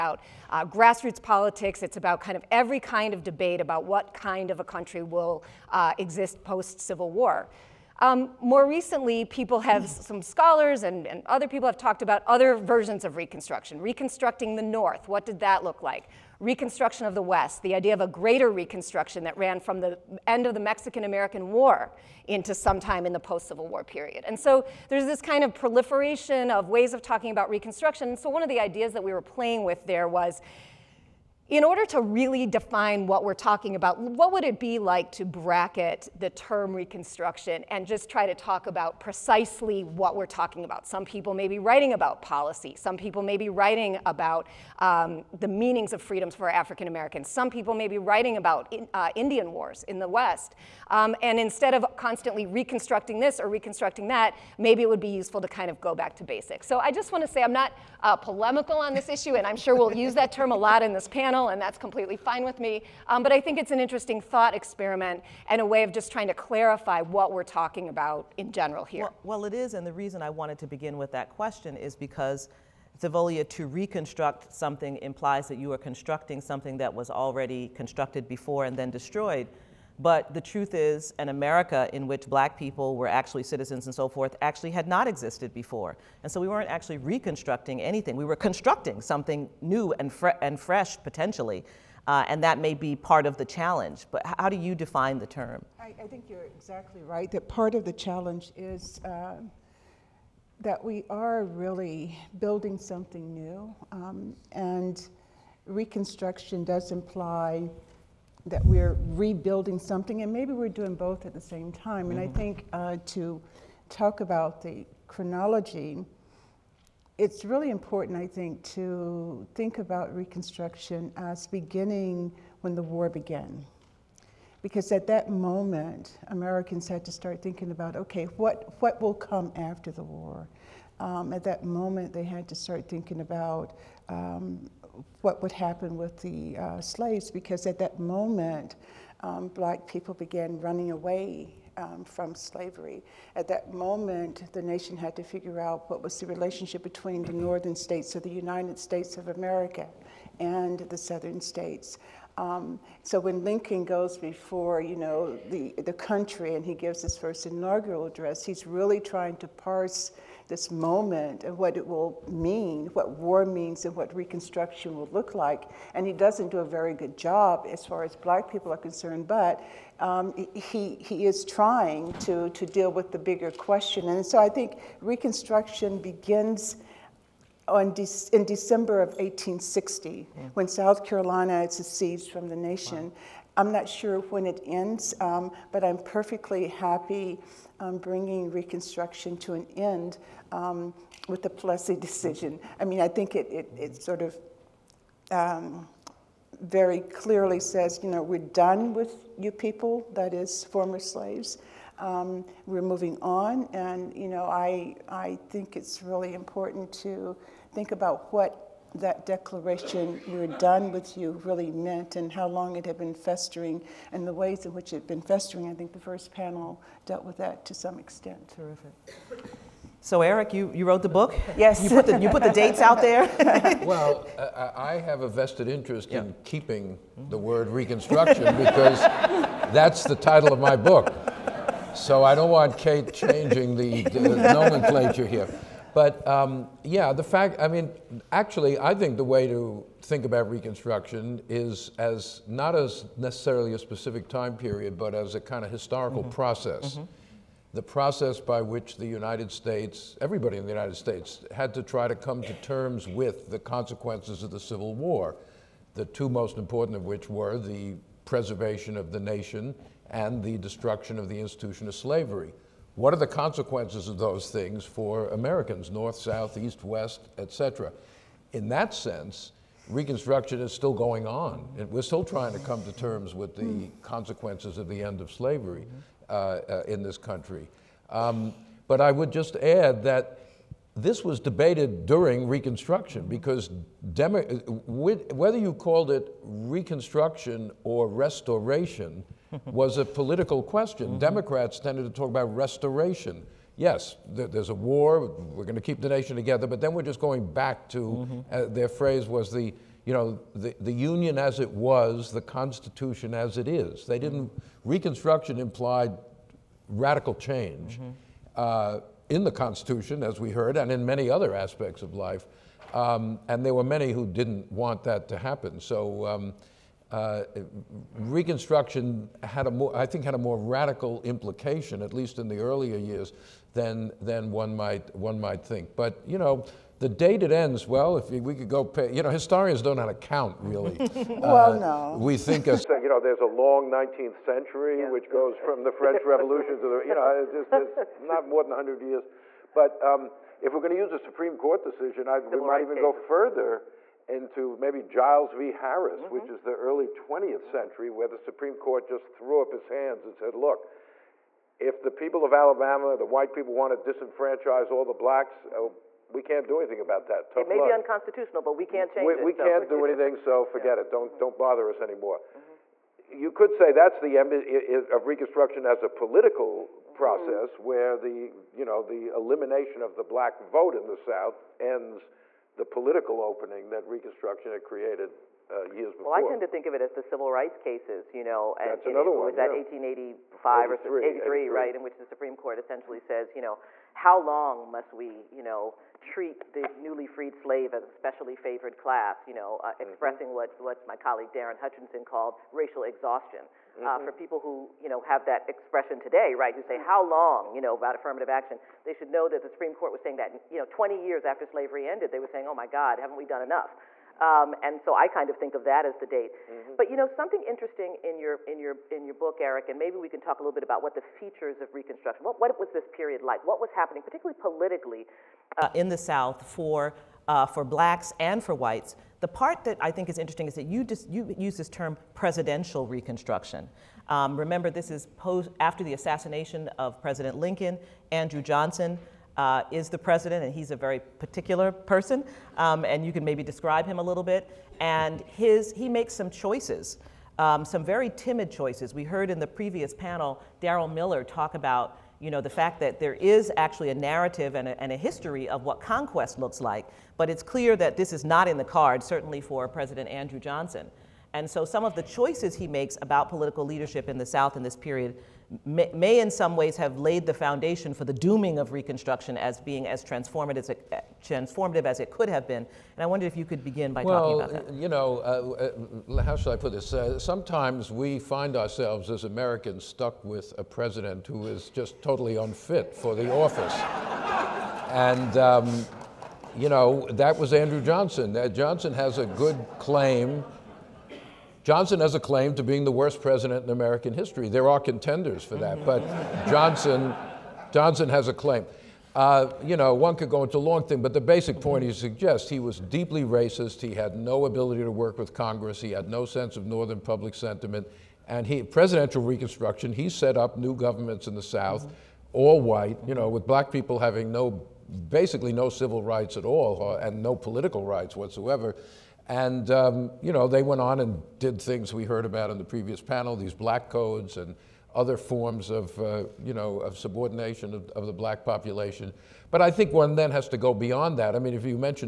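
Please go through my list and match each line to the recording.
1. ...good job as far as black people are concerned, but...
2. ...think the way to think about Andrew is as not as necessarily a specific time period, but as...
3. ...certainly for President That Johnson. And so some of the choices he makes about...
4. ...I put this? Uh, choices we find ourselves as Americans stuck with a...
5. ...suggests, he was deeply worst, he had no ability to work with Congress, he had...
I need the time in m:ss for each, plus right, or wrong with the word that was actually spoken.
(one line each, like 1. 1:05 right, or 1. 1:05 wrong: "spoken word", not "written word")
1. 2:46 right
2. 3:58 wrong: "Reconstruction", not "Andrew"
3. 7:29 wrong: "Andrew", not "That"
4. 7:46 wrong: "sometimes", not "choices"
5. 8:12 wrong: "racist", not "worst".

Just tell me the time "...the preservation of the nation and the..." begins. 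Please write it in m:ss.
4:17.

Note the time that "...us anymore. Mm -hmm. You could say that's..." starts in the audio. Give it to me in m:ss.
6:01.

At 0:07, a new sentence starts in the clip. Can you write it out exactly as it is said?
Um, more recently, people have, some scholars and, and, other people have talked about other versions of Reconstruction.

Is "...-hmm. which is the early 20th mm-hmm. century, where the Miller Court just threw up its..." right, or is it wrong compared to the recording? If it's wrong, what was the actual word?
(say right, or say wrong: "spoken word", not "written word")
wrong: "Supreme", not "Miller".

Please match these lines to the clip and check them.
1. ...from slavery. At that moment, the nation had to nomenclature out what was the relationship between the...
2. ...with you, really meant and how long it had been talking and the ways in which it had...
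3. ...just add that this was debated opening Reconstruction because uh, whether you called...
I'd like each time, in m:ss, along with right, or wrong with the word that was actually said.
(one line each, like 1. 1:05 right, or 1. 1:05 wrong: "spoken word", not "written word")
1. 2:22 wrong: "figure", not "nomenclature"
2. 3:30 wrong: "festering", not "talking"
3. 4:39 wrong: "during", not "opening".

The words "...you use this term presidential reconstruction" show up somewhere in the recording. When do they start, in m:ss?
7:01.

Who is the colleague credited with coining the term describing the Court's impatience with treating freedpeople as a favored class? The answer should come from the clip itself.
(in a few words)
Darren Hutchinson.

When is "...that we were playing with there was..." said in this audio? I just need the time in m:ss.
0:28.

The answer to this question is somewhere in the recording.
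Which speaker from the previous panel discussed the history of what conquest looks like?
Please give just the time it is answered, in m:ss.
7:20.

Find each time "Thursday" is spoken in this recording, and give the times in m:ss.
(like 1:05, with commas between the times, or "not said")
not said.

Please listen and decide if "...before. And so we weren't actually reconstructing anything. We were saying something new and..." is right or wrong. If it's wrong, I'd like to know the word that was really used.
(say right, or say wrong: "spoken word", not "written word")
wrong: "constructing", not "saying".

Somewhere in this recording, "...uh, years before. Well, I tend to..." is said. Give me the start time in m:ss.
6:15.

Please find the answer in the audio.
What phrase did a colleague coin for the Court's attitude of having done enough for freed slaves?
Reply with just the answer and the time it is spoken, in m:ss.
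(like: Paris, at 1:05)
racial exhaustion, at 6:32.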